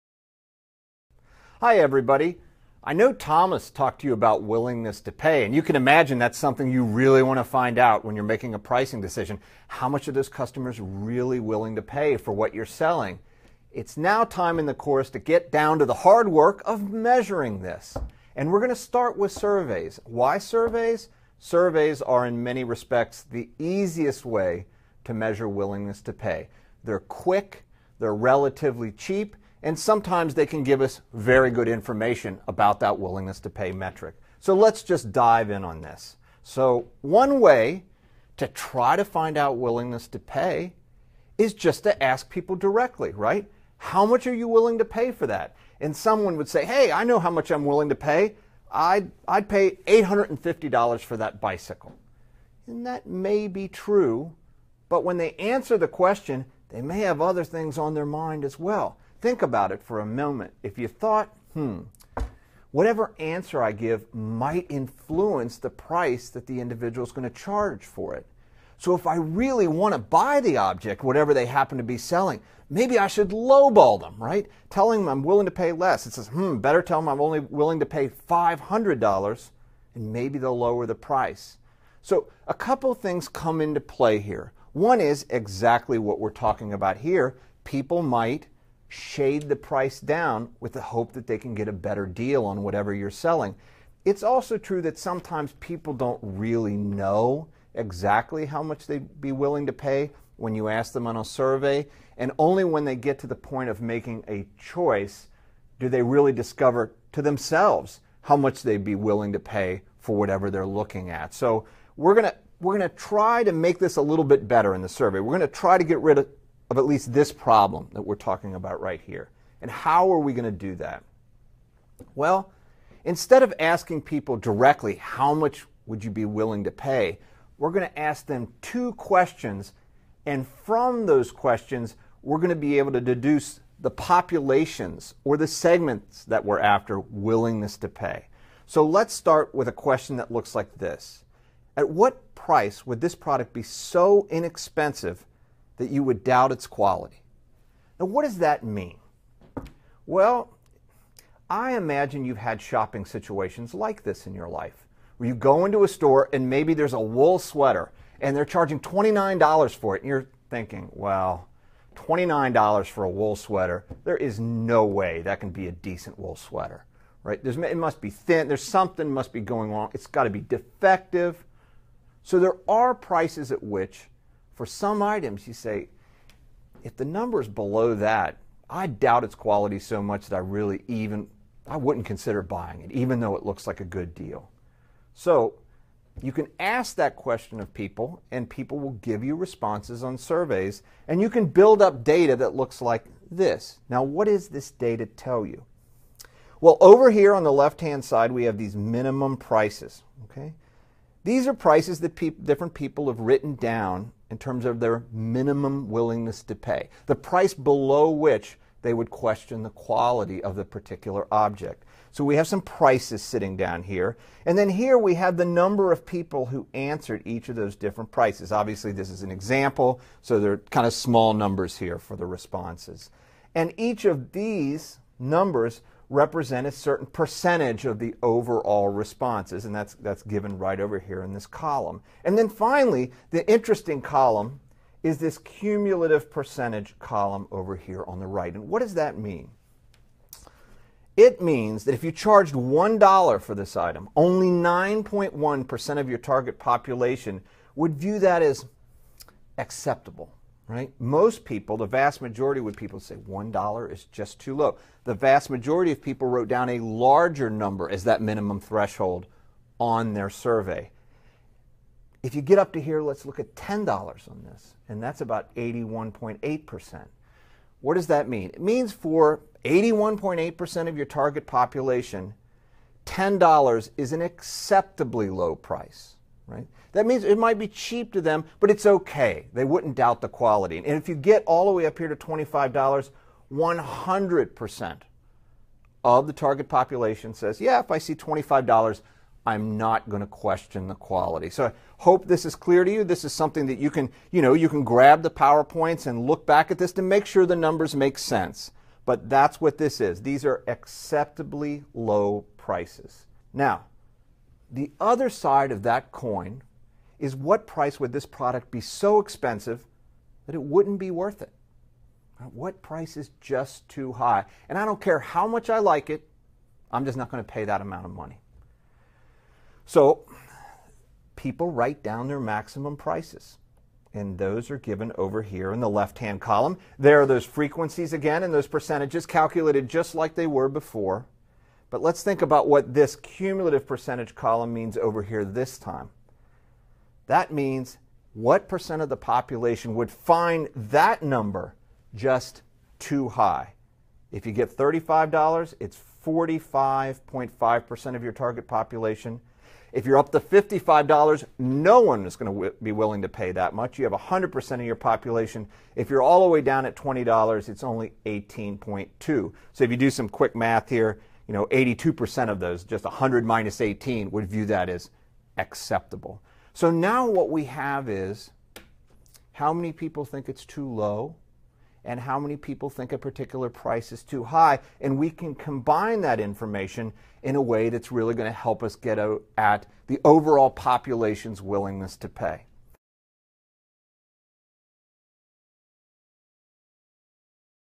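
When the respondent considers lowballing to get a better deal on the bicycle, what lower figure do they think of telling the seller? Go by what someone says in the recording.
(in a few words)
$500.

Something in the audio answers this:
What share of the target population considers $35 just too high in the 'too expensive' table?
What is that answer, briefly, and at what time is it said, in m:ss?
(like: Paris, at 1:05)
45.5%, at 5:46.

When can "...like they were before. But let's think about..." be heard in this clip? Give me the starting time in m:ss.
5:30.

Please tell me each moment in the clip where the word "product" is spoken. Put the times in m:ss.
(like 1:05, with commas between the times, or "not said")
2:23, 5:08.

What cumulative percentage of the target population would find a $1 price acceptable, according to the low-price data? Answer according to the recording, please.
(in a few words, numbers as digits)
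9.1%.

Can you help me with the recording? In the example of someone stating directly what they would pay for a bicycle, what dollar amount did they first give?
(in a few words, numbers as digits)
$850.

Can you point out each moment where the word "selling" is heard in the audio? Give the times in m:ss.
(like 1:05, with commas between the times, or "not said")
0:12, 1:11, 1:33.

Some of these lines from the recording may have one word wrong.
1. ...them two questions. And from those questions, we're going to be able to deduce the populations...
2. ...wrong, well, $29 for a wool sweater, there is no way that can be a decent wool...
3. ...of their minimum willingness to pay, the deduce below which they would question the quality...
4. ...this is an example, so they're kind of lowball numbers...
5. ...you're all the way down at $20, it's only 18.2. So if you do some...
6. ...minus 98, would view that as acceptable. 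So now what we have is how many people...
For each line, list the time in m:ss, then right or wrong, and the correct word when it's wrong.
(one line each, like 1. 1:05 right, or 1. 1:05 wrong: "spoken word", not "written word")
1. 2:08 right
2. 2:40 wrong: "thinking", not "wrong"
3. 3:24 wrong: "price", not "deduce"
4. 3:38 wrong: "small", not "lowball"
5. 5:56 right
6. 6:03 wrong: "18", not "98".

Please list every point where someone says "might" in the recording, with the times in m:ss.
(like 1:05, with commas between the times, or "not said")
1:04, 1:28, 4:37.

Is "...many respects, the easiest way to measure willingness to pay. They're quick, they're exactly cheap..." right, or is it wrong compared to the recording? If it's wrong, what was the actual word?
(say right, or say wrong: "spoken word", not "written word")
wrong: "relatively", not "exactly".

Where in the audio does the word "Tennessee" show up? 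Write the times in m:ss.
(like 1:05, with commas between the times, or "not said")
not said.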